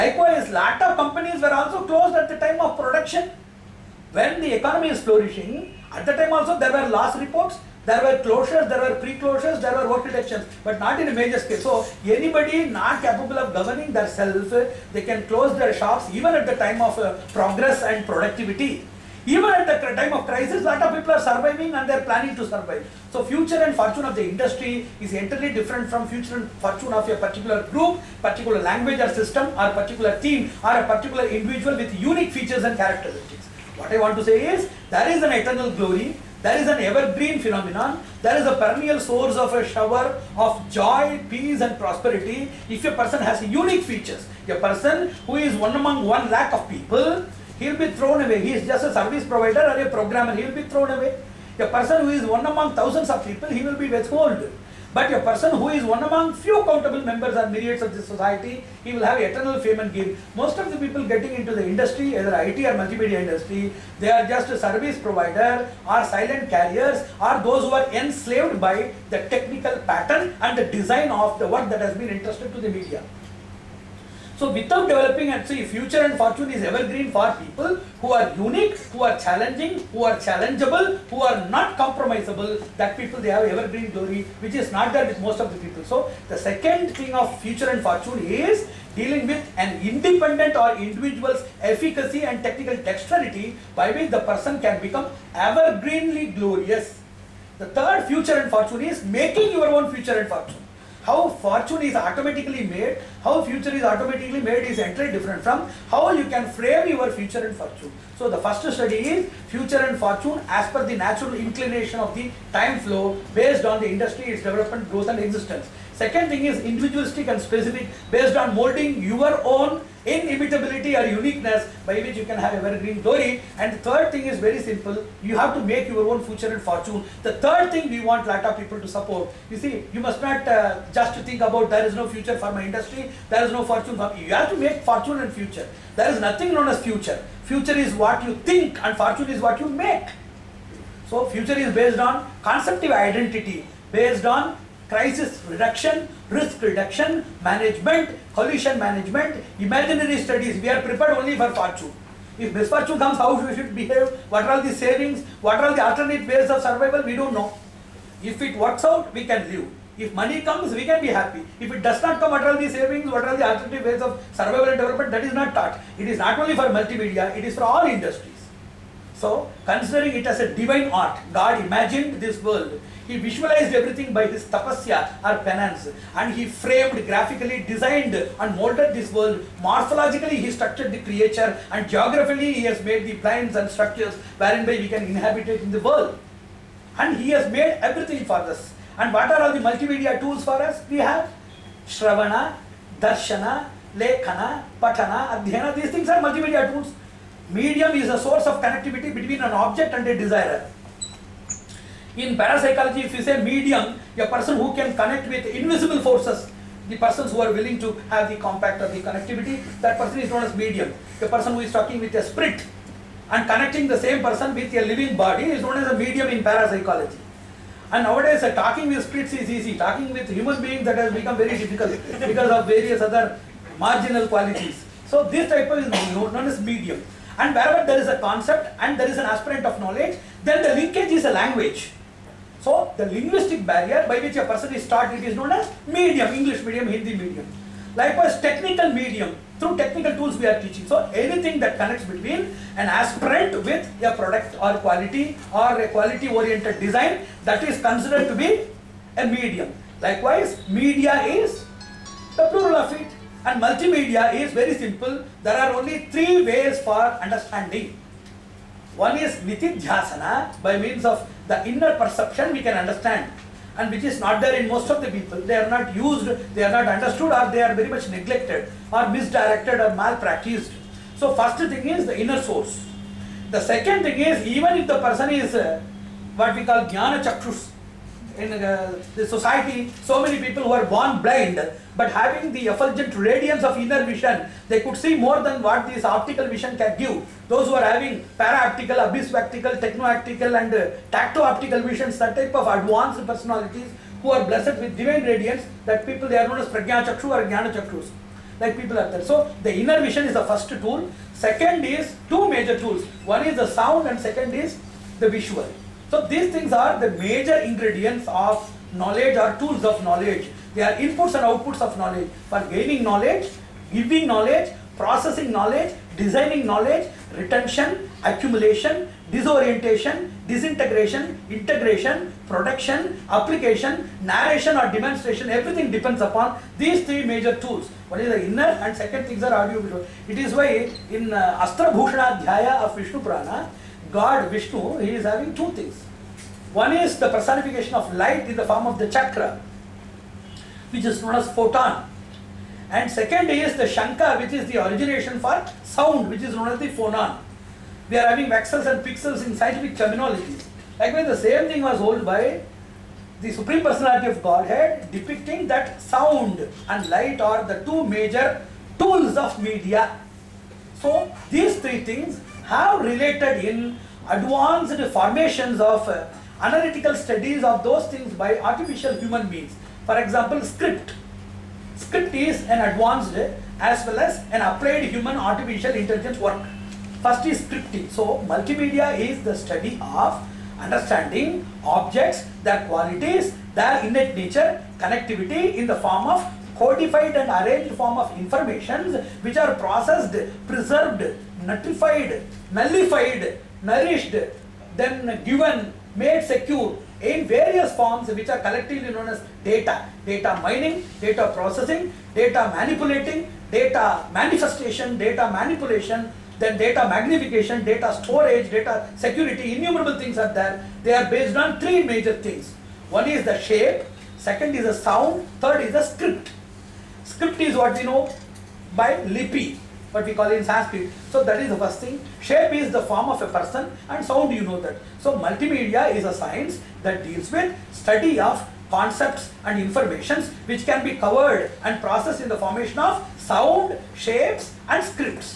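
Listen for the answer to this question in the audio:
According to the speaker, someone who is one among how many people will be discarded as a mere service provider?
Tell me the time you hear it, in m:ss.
0:46.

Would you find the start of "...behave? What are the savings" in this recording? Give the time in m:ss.
2:33.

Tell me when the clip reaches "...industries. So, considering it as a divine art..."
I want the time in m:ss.
2:47.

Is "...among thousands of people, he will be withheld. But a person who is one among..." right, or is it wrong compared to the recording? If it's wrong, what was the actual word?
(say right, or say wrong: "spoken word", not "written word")
right.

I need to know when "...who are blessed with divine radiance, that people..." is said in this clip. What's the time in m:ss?
4:54.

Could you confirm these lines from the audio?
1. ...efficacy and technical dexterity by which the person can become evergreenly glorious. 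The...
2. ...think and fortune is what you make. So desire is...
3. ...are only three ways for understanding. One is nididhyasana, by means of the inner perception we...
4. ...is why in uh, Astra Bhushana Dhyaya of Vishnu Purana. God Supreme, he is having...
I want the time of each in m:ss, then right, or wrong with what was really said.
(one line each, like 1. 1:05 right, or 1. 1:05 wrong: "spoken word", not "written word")
1. 1:31 right
2. 2:18 wrong: "future", not "desire"
3. 4:15 right
4. 5:30 wrong: "Vishnu", not "Supreme".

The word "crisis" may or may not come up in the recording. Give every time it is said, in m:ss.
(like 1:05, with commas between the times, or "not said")
0:20, 2:24.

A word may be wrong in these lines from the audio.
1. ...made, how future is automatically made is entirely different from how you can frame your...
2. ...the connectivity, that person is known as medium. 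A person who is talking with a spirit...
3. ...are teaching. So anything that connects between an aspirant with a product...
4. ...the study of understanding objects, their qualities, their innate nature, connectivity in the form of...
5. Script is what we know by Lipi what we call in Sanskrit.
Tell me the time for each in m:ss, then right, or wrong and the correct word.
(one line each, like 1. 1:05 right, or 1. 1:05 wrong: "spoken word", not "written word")
1. 1:42 right
2. 3:28 right
3. 4:00 right
4. 6:19 right
5. 6:57 right.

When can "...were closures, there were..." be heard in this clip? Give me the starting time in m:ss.
0:08.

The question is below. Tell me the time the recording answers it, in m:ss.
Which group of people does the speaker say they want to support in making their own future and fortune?
2:08.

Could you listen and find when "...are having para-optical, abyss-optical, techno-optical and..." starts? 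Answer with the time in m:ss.
4:47.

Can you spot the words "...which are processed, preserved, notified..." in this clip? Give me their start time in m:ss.
6:29.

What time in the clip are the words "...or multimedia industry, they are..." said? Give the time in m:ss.
1:02.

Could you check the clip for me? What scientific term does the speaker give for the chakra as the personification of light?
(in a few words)
Photon.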